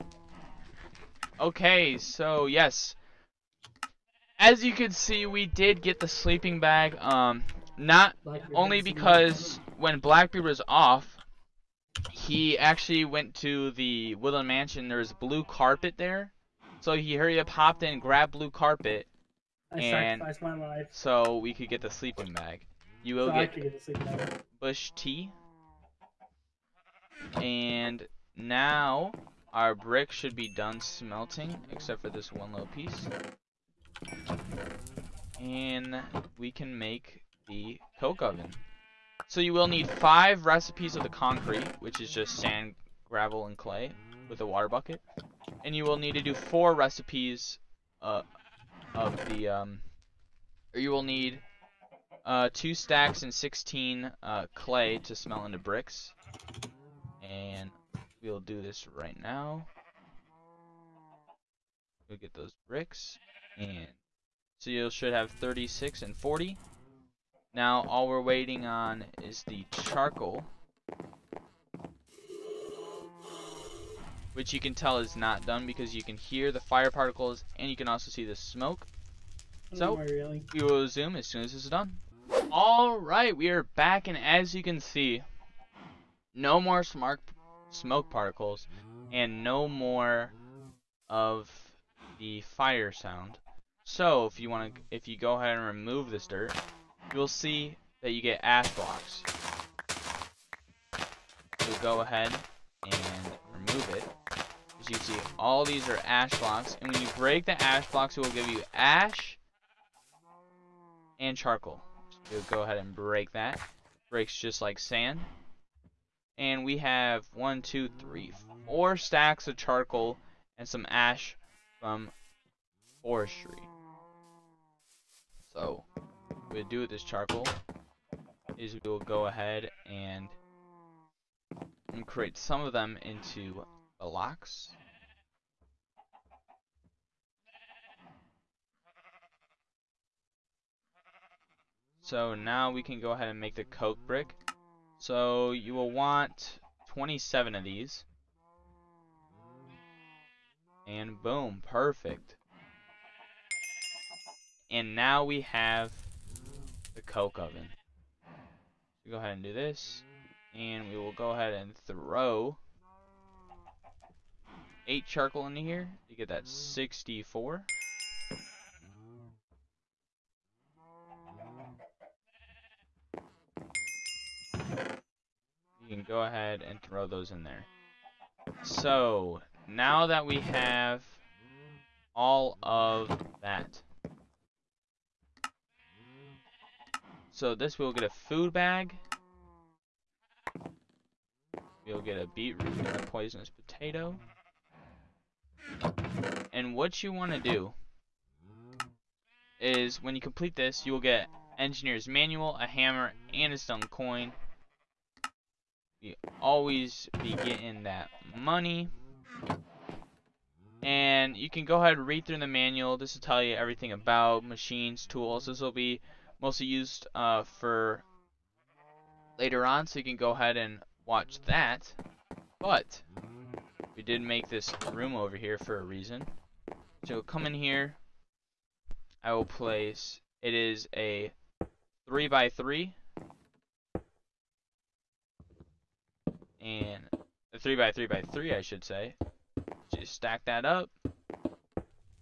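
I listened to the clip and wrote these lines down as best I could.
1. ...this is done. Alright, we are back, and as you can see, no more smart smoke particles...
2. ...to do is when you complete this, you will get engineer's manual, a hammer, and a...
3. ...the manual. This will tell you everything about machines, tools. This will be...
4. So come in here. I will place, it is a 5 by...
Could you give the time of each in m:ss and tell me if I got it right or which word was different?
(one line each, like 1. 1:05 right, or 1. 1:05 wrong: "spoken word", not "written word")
1. 1:21 right
2. 3:17 right
3. 3:32 right
4. 3:47 wrong: "3", not "5".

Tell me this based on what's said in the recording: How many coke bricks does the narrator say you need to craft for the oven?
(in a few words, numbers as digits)
27.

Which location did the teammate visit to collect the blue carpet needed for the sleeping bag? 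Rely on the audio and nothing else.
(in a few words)
Woodland Mansion.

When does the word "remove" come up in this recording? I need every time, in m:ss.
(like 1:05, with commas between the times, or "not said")
1:35, 1:43.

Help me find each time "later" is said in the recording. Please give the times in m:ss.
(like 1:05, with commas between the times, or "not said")
3:39.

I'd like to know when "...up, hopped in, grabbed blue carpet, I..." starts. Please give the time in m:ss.
0:17.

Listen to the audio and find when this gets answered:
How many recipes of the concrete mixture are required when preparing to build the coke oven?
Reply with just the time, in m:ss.
0:39.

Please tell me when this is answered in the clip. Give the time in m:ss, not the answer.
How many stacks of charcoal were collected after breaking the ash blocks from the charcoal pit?
1:58.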